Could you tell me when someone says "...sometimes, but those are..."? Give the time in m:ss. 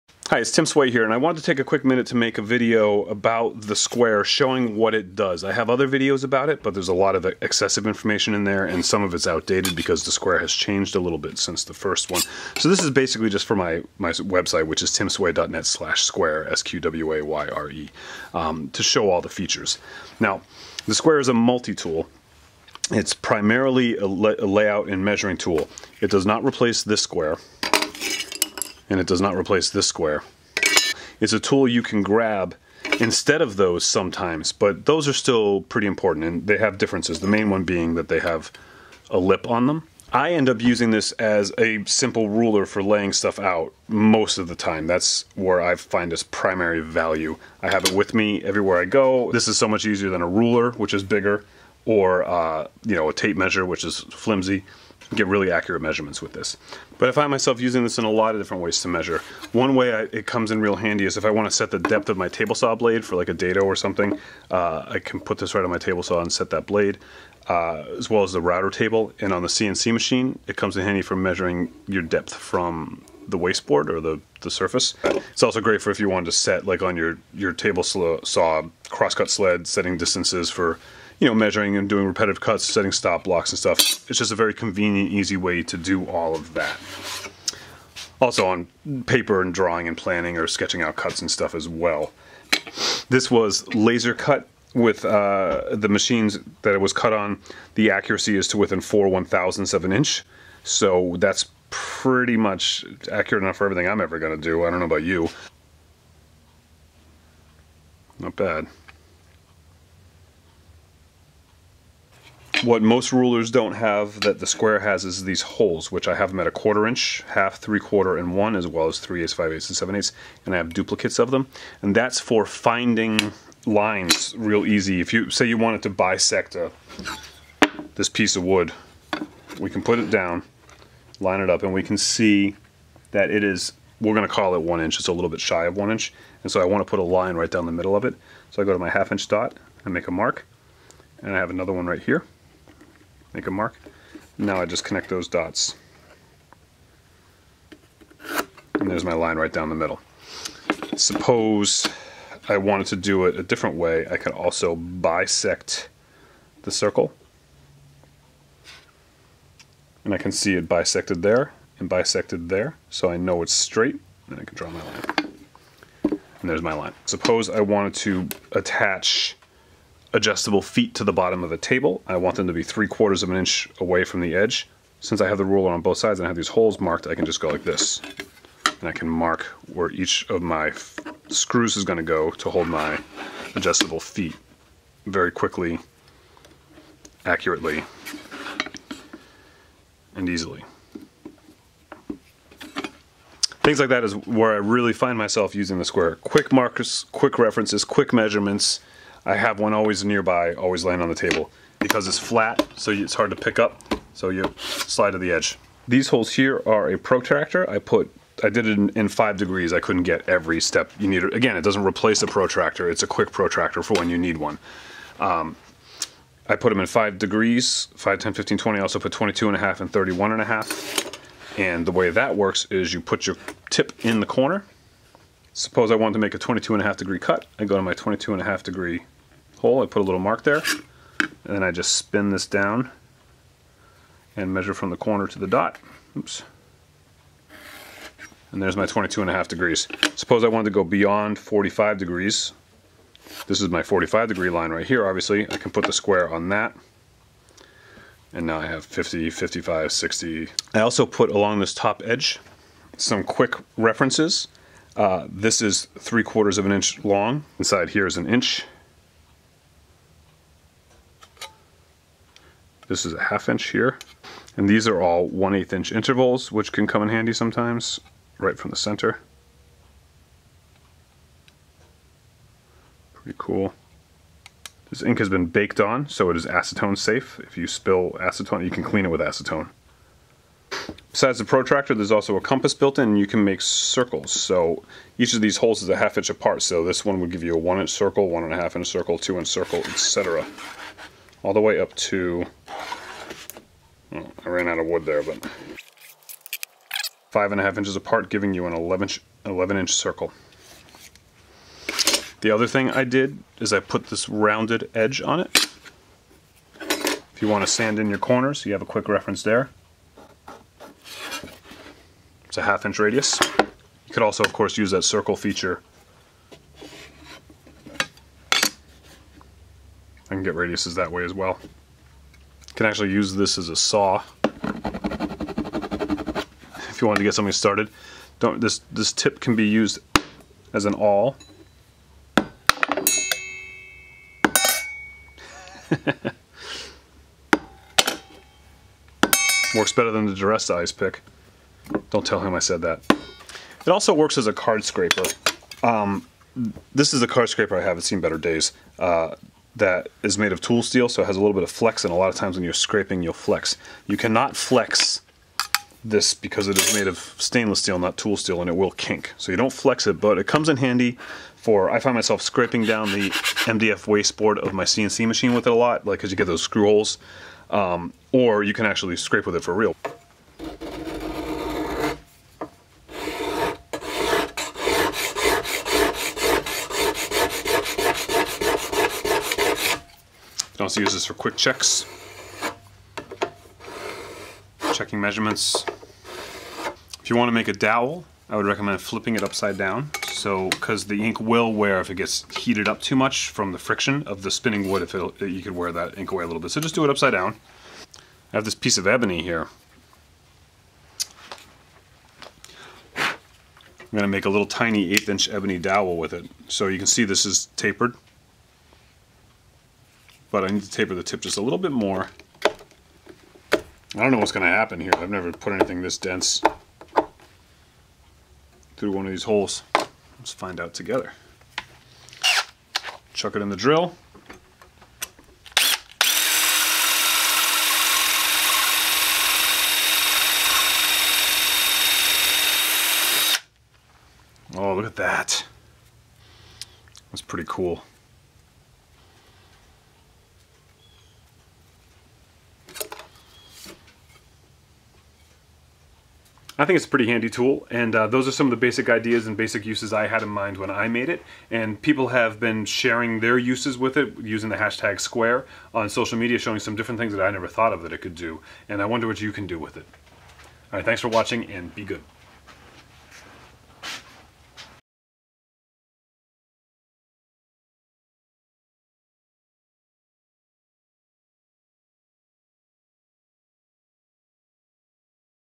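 0:33.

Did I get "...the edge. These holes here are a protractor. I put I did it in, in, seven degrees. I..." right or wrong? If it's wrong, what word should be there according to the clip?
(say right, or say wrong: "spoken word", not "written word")
wrong: "five", not "seven".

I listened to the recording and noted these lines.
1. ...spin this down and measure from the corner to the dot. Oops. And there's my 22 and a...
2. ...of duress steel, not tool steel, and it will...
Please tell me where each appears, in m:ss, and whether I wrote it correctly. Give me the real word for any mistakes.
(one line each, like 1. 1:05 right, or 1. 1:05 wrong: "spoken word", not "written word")
1. 3:51 right
2. 5:57 wrong: "stainless", not "duress".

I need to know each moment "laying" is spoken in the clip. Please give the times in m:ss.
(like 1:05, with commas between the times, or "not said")
0:42, 3:20.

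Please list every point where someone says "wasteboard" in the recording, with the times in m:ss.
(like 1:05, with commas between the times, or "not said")
1:13, 6:04.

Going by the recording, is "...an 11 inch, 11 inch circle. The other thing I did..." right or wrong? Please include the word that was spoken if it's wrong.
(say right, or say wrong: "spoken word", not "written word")
right.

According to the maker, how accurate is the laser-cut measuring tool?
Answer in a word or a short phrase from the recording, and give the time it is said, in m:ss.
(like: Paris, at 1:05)
4 thousandths of an inch, at 1:38.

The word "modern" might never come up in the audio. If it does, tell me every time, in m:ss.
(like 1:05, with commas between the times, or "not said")
not said.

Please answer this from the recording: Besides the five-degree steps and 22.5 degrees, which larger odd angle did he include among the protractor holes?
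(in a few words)
31.5 degrees.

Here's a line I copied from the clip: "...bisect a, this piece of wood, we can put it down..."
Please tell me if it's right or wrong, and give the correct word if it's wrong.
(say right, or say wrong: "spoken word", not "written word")
right.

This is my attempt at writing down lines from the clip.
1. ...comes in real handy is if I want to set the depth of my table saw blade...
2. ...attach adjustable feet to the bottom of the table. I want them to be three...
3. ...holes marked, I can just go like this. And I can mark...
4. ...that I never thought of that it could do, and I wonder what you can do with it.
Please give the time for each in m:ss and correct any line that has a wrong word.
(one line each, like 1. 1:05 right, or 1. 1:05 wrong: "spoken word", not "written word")
1. 1:00 right
2. 2:48 right
3. 2:56 right
4. 7:37 right.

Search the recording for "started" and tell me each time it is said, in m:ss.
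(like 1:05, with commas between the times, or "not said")
5:27.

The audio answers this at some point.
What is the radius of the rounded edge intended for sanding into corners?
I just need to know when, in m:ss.
5:12.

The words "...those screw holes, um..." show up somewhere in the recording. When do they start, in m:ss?
6:06.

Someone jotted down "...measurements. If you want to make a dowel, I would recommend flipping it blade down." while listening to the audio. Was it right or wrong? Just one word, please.
wrong.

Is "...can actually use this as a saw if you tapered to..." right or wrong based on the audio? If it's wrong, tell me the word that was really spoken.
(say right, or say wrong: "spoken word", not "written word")
wrong: "wanted", not "tapered".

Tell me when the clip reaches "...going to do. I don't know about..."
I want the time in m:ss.
1:44.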